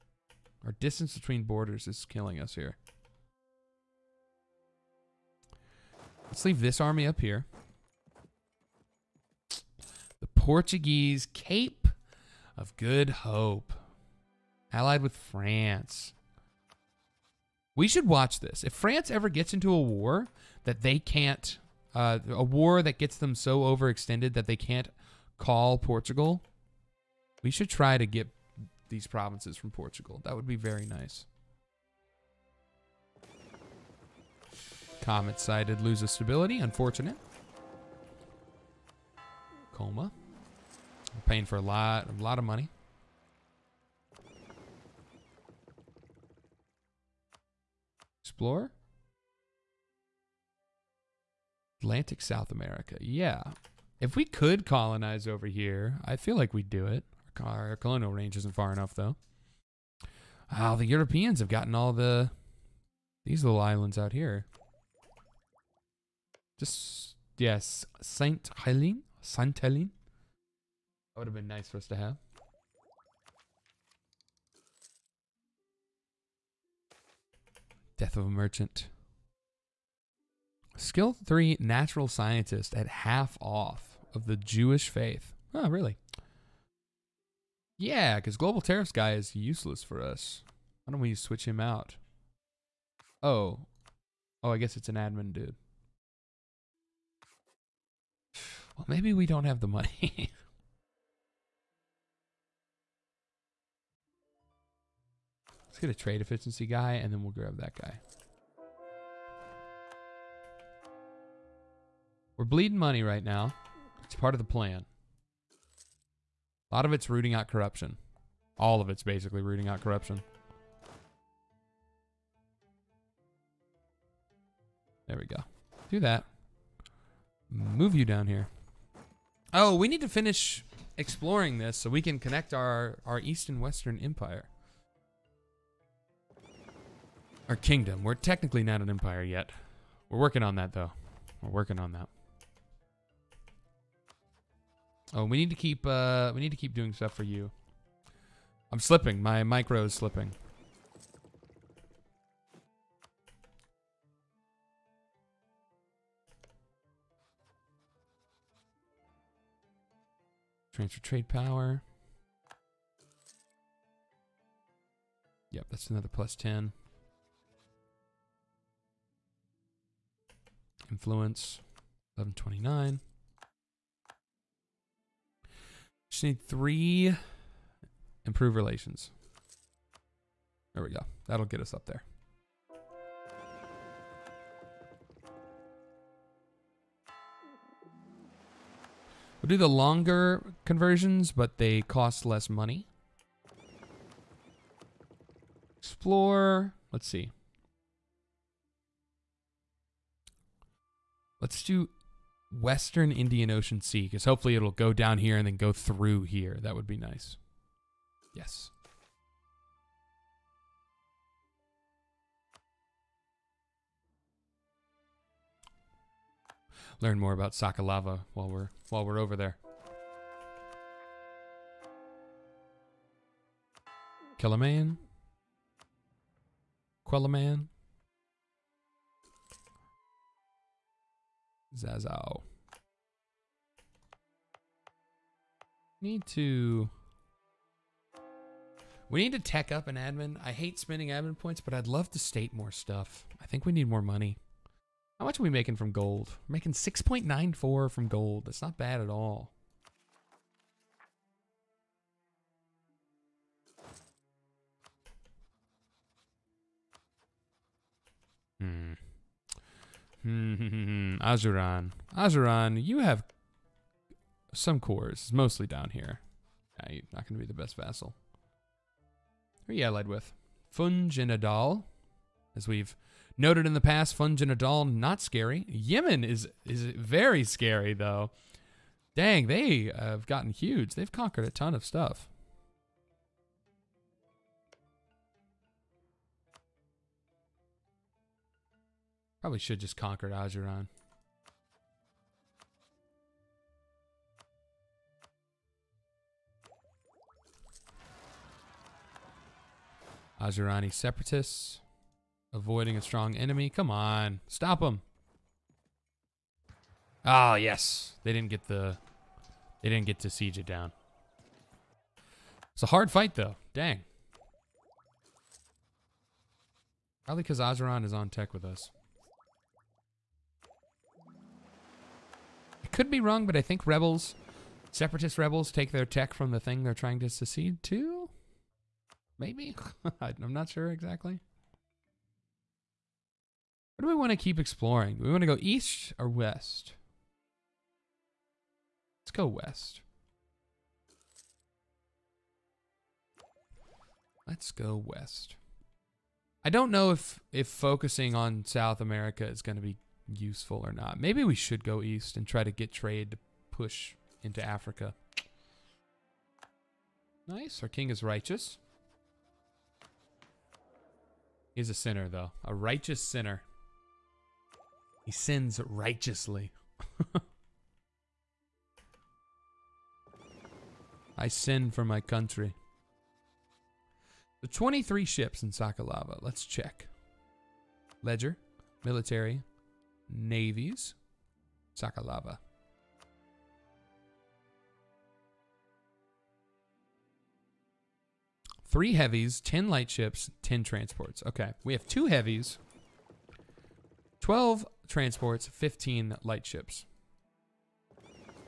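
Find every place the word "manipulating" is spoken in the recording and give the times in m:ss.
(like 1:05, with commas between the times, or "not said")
not said.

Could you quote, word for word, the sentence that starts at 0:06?
Let's leave this army up here.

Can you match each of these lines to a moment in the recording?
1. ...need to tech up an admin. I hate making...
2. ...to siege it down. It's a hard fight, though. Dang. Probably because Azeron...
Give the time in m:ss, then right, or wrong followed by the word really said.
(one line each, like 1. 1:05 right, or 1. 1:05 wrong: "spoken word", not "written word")
1. 3:59 wrong: "spending", not "making"
2. 5:10 right.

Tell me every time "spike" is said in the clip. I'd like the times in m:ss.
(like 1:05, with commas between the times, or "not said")
not said.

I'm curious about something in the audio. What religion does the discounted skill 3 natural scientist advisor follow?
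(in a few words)
Jewish.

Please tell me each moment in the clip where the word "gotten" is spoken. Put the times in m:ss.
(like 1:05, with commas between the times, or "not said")
1:01, 4:40.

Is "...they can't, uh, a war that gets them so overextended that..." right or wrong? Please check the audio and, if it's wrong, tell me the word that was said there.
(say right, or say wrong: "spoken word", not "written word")
right.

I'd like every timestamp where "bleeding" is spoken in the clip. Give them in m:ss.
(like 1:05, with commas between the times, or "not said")
1:52.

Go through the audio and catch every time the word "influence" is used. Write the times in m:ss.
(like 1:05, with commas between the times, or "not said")
2:50.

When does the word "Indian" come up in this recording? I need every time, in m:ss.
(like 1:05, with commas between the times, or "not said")
3:23.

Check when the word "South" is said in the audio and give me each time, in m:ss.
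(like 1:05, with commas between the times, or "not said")
0:52, 5:48.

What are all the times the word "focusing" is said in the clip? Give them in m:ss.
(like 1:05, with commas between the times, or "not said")
5:47.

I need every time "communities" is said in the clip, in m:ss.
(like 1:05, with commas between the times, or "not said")
not said.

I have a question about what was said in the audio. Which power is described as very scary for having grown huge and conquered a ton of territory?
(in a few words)
Yemen.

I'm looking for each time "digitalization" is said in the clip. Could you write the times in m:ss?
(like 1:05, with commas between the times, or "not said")
not said.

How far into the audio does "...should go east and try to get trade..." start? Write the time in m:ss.
5:51.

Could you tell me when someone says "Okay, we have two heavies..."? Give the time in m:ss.
6:31.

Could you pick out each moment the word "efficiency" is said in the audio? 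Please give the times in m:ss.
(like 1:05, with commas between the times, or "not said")
1:46.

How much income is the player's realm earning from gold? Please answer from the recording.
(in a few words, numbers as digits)
6.94.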